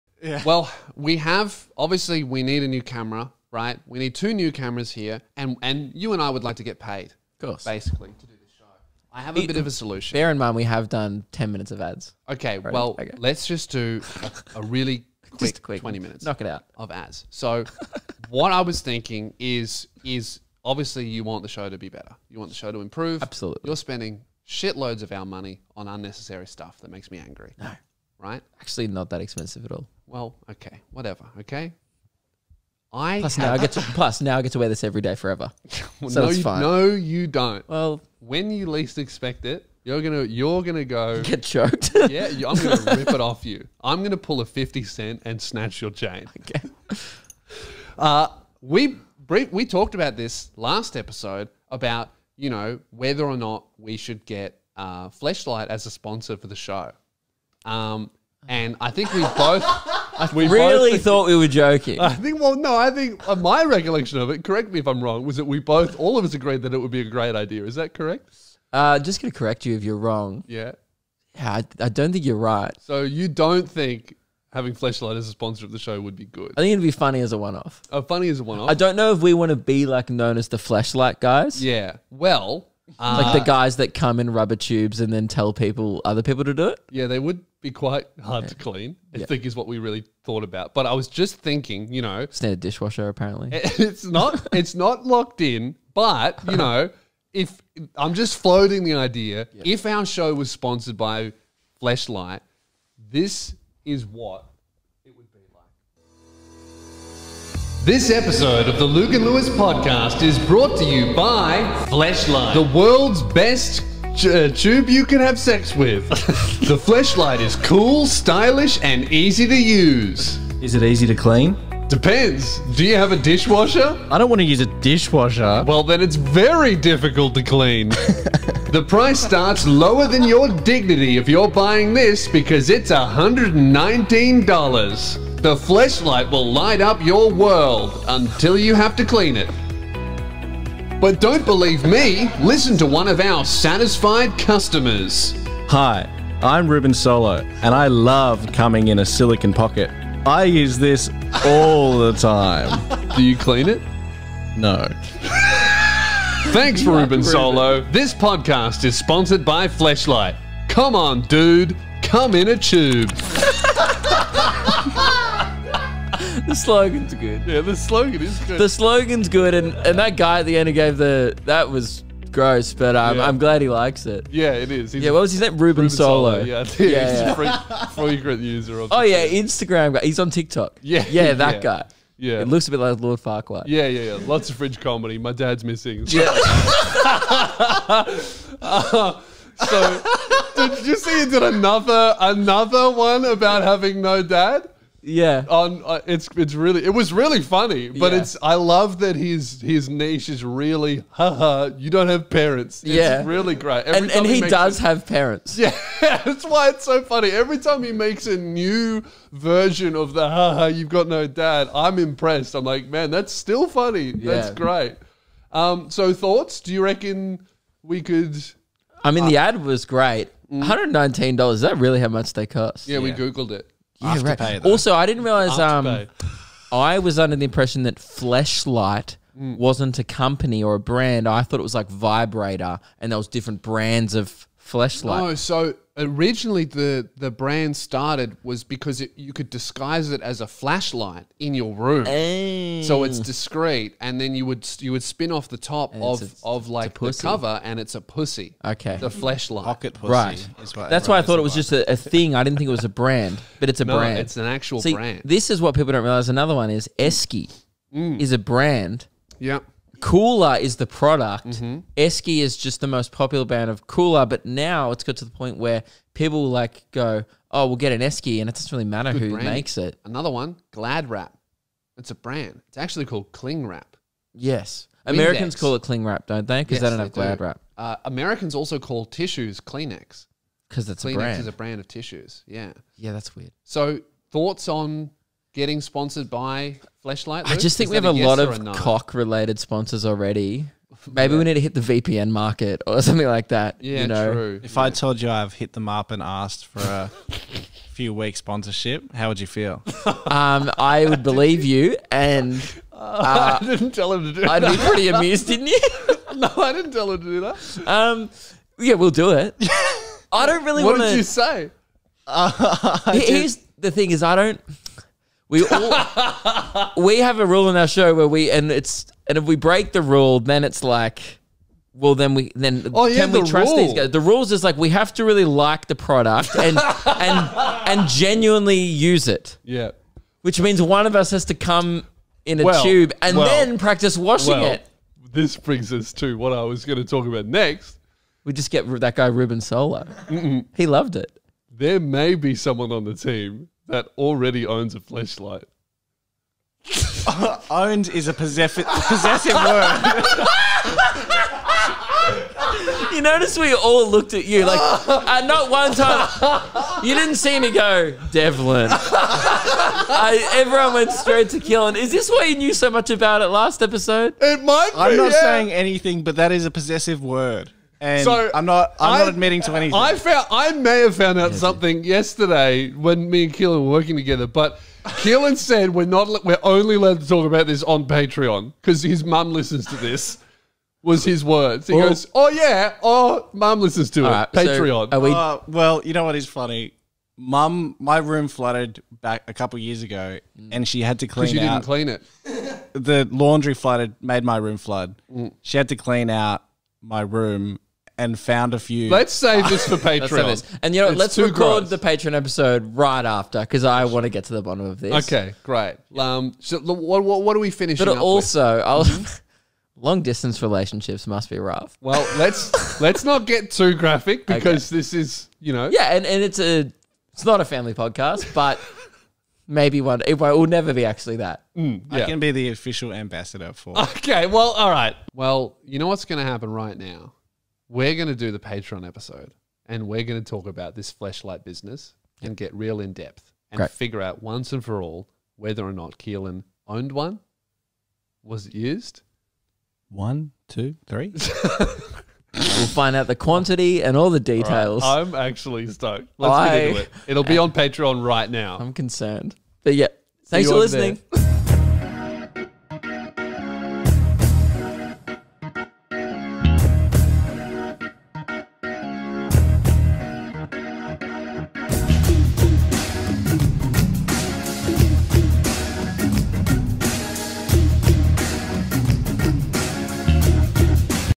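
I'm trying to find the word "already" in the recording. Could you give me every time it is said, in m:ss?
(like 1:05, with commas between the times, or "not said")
0:12, 4:50, 5:44.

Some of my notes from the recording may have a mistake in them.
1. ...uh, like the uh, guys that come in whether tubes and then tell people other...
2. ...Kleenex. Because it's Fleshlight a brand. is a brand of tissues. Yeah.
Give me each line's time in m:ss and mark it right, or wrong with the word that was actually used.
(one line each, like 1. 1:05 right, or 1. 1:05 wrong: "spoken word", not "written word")
1. 1:22 wrong: "rubber", not "whether"
2. 4:39 wrong: "Kleenex", not "Fleshlight".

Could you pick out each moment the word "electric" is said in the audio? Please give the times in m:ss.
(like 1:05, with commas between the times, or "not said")
not said.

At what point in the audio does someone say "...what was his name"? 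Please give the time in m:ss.
2:55.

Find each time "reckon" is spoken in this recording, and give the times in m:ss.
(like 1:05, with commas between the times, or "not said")
3:36.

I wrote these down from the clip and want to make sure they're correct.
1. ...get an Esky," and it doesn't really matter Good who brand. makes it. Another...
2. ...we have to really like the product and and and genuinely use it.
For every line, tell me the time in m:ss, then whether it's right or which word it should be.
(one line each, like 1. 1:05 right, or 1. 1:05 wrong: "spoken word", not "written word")
1. 4:27 right
2. 5:24 right.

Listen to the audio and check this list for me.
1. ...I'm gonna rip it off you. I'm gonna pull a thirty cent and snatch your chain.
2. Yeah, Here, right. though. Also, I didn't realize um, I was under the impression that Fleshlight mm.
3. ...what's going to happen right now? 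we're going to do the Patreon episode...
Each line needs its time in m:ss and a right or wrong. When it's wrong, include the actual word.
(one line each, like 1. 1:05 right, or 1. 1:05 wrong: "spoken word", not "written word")
1. 0:42 wrong: "fifty", not "thirty"
2. 3:44 wrong: "Afterpay", not "Here"
3. 7:06 right.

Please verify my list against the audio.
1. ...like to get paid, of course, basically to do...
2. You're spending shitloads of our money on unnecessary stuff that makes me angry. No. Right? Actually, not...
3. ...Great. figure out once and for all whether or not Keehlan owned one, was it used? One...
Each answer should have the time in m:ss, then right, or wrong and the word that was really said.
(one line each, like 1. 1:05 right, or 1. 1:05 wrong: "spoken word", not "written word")
1. 0:06 right
2. 0:23 right
3. 7:13 right.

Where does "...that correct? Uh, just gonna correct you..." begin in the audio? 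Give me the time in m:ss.
1:07.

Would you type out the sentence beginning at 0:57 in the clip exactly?
Um, and I think we both.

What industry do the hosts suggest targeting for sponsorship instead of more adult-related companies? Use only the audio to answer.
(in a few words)
VPN.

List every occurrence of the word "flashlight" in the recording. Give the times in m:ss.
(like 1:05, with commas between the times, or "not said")
2:15, 4:00, 4:09.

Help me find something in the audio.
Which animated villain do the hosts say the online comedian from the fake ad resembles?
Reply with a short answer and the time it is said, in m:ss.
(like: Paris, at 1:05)
Lord Farquaad, at 3:03.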